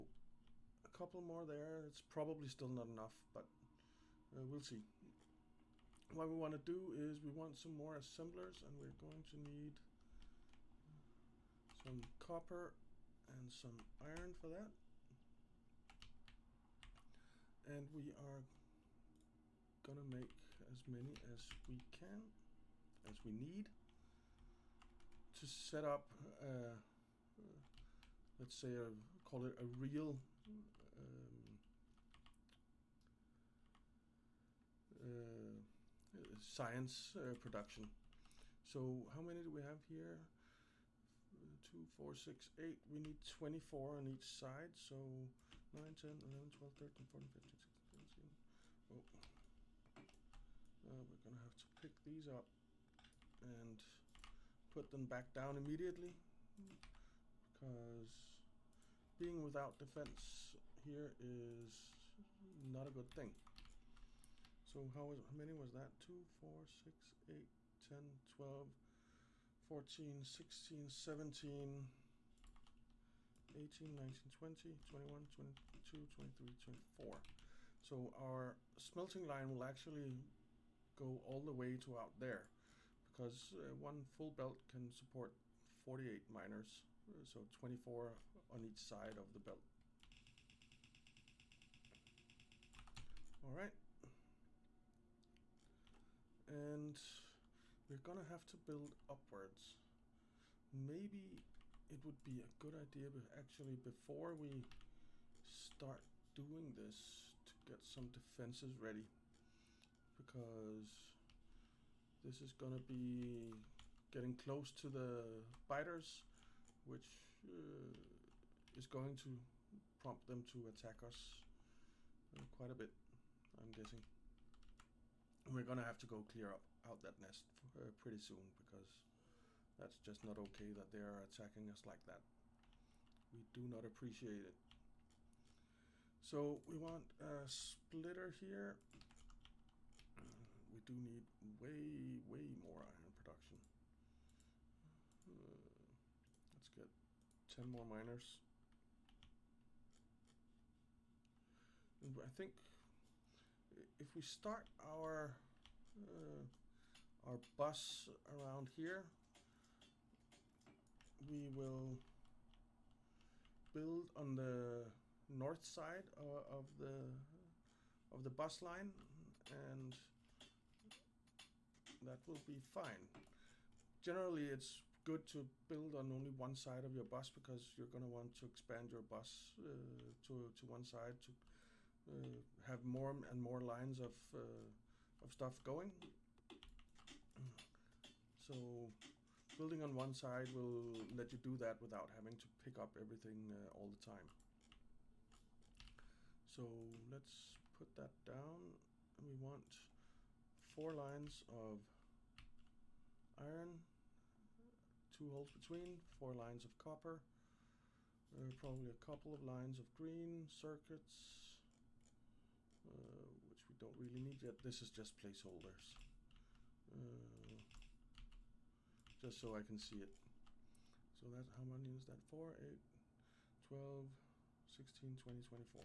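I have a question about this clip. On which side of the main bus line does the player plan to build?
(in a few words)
North side.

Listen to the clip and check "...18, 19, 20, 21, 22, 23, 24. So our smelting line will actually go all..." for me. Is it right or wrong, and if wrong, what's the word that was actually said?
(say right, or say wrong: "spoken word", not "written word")
right.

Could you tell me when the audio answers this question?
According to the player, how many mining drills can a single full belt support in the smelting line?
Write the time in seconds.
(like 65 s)
85 s.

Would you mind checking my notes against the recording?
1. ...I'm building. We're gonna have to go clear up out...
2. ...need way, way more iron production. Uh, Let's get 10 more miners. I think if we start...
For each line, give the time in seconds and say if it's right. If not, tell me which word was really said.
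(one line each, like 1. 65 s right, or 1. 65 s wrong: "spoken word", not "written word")
1. 123 s wrong: "guessing", not "building"
2. 140 s right.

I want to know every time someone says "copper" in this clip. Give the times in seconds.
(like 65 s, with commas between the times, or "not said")
12 s, 206 s.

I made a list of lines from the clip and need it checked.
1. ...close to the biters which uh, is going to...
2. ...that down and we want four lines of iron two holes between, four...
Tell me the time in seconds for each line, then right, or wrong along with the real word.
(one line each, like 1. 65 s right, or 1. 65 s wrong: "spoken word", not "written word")
1. 114 s right
2. 197 s right.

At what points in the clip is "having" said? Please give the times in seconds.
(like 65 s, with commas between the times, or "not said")
192 s.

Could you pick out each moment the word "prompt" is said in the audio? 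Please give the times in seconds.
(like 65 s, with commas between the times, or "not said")
119 s.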